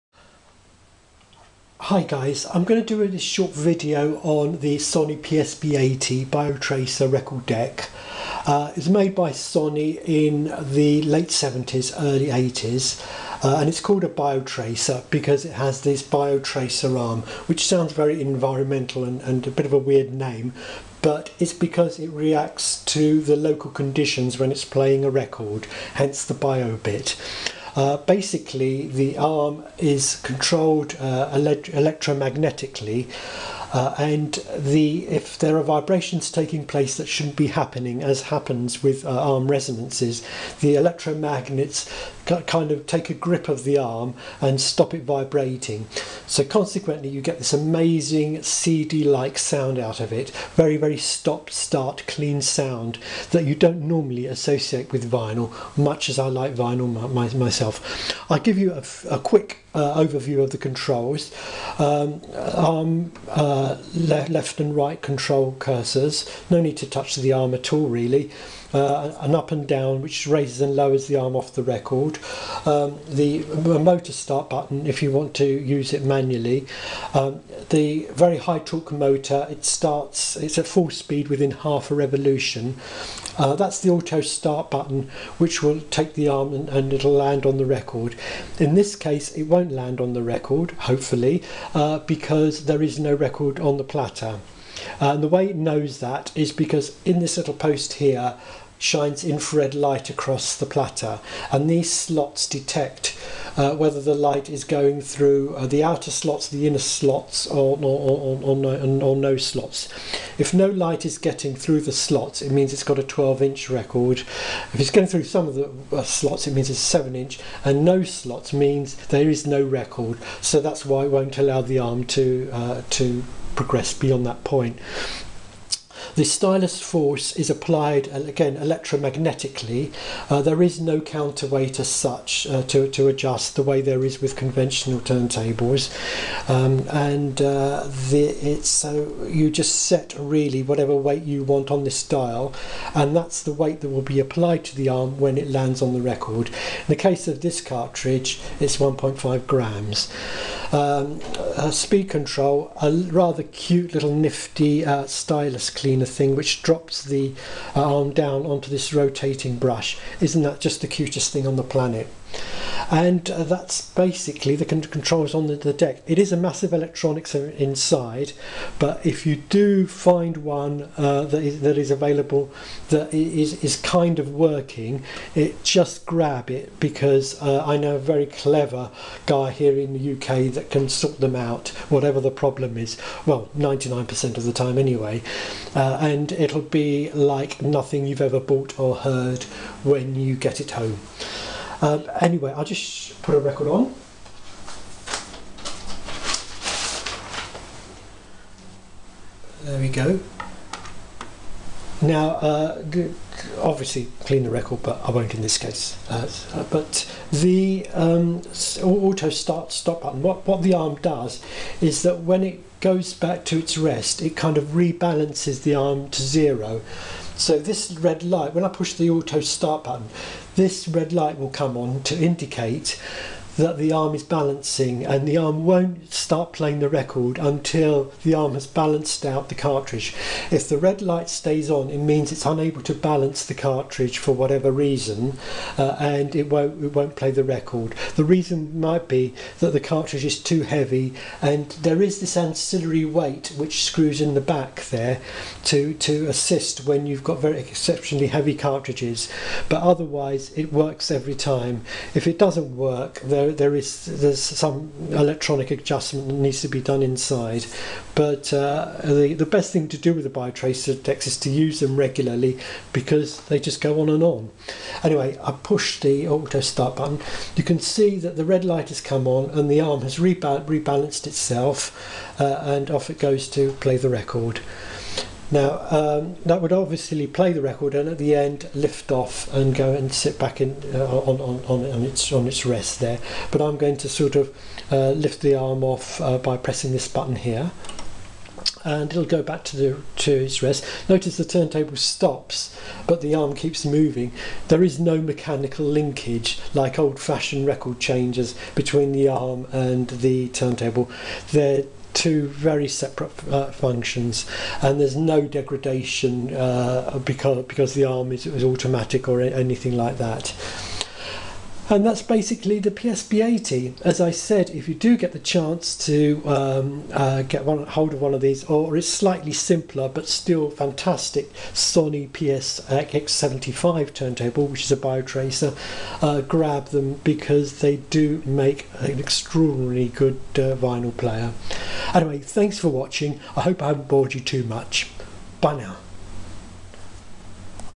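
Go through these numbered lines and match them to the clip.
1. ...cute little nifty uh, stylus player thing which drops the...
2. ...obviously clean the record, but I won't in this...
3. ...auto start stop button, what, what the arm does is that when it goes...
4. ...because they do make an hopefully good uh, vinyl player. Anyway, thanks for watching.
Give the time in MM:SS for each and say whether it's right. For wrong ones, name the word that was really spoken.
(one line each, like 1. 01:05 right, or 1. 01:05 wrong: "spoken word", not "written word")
1. 02:33 wrong: "cleaner", not "player"
2. 03:23 right
3. 03:28 right
4. 05:27 wrong: "extraordinarily", not "hopefully".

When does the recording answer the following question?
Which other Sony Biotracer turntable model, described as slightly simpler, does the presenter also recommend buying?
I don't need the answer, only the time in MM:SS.
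05:22.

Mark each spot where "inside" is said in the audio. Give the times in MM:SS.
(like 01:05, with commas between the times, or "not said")
02:47, 04:17.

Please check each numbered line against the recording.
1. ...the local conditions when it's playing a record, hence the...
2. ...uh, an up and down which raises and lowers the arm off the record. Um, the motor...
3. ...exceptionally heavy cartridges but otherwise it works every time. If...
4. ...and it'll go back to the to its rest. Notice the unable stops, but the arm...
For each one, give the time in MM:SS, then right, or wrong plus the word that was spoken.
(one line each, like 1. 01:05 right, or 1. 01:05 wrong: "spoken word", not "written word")
1. 00:23 right
2. 01:08 right
3. 04:07 right
4. 04:48 wrong: "turntable", not "unable".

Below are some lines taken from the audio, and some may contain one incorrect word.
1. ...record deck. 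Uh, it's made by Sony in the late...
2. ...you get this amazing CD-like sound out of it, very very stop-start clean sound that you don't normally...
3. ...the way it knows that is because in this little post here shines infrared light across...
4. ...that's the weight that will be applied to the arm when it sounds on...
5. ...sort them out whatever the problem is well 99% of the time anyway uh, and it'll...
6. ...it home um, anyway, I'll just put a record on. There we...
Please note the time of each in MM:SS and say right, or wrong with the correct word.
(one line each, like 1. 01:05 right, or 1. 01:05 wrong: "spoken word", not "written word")
1. 00:07 right
2. 00:47 right
3. 01:35 right
4. 02:23 wrong: "lands", not "sounds"
5. 03:00 right
6. 03:10 right.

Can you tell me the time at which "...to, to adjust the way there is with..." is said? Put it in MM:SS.
02:12.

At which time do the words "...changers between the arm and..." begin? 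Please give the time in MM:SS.
04:57.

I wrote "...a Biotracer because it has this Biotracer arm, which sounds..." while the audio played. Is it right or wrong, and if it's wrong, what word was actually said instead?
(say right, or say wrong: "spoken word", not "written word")
right.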